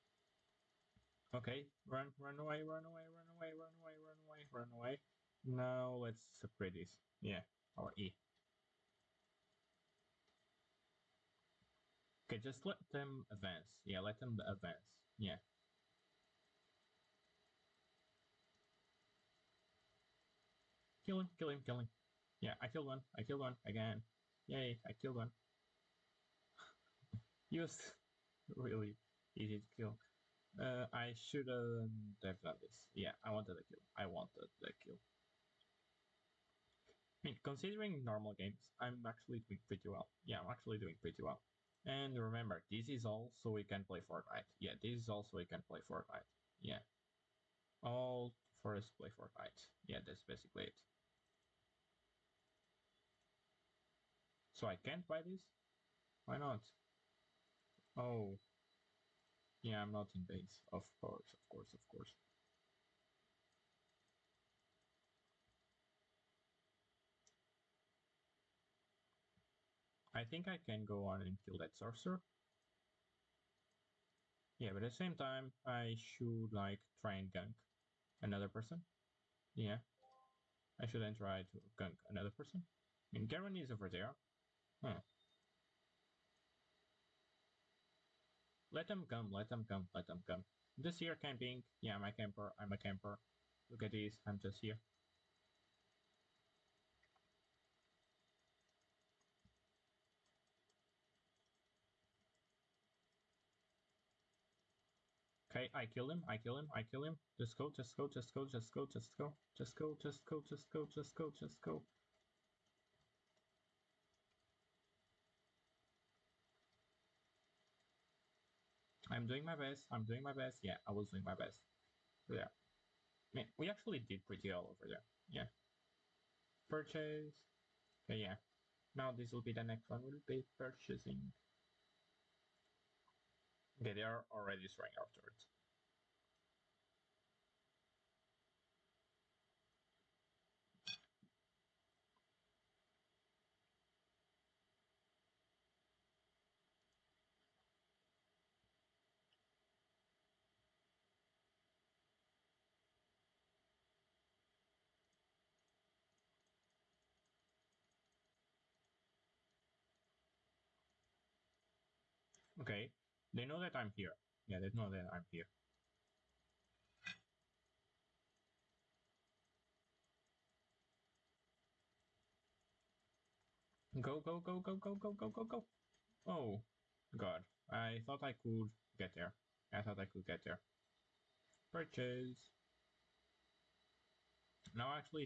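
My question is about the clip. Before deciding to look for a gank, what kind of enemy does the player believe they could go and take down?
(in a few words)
sorcerer.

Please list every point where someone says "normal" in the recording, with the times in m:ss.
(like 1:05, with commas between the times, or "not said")
0:38.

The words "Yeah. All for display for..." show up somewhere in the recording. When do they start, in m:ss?
0:46.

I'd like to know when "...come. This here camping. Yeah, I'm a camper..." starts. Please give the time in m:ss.
1:30.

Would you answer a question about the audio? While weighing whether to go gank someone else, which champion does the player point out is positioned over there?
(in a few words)
Garen.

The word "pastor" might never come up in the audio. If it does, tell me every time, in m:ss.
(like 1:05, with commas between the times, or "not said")
not said.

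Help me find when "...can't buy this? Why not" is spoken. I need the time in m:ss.
0:54.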